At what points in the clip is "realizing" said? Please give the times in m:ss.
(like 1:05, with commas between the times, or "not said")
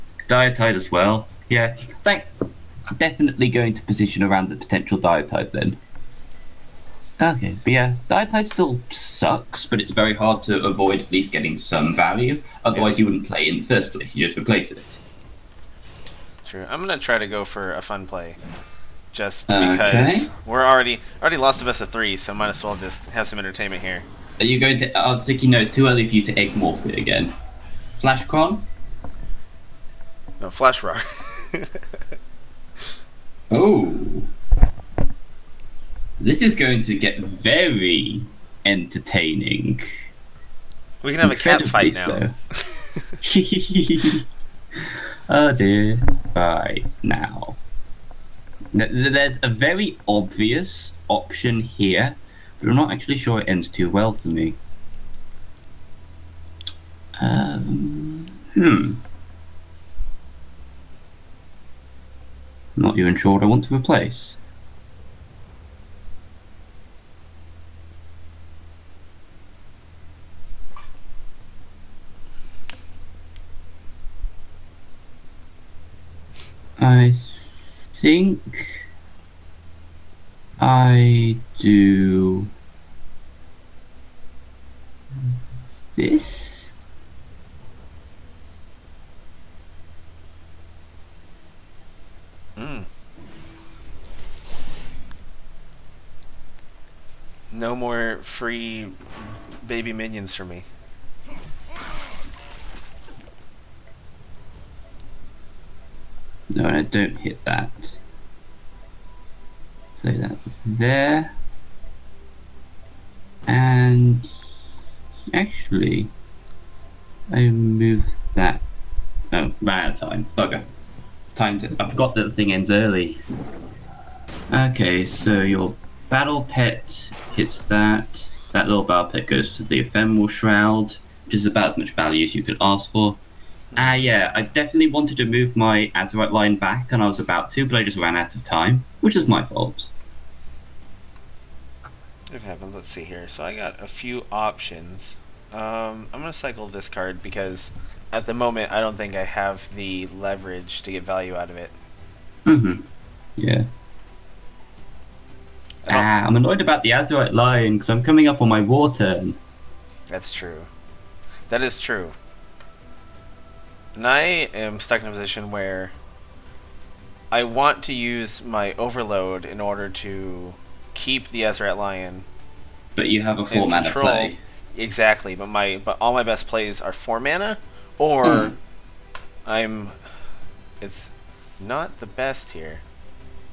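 not said.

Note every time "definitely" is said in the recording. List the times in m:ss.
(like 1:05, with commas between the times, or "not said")
0:02, 2:14.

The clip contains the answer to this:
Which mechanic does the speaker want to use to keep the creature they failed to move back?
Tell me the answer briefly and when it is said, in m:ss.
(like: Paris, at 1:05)
Overload, at 2:48.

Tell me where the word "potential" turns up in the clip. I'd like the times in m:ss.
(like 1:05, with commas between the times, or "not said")
0:04.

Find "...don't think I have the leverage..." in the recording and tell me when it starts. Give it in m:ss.
2:28.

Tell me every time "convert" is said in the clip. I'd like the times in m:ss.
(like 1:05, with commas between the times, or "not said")
not said.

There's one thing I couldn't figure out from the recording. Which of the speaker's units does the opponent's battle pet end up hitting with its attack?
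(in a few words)
Ephemeral Shroud.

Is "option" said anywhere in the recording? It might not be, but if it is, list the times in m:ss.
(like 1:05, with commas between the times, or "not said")
0:51, 2:24.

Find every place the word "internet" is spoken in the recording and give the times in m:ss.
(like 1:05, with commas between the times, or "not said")
not said.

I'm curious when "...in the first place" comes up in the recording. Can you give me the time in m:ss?
0:13.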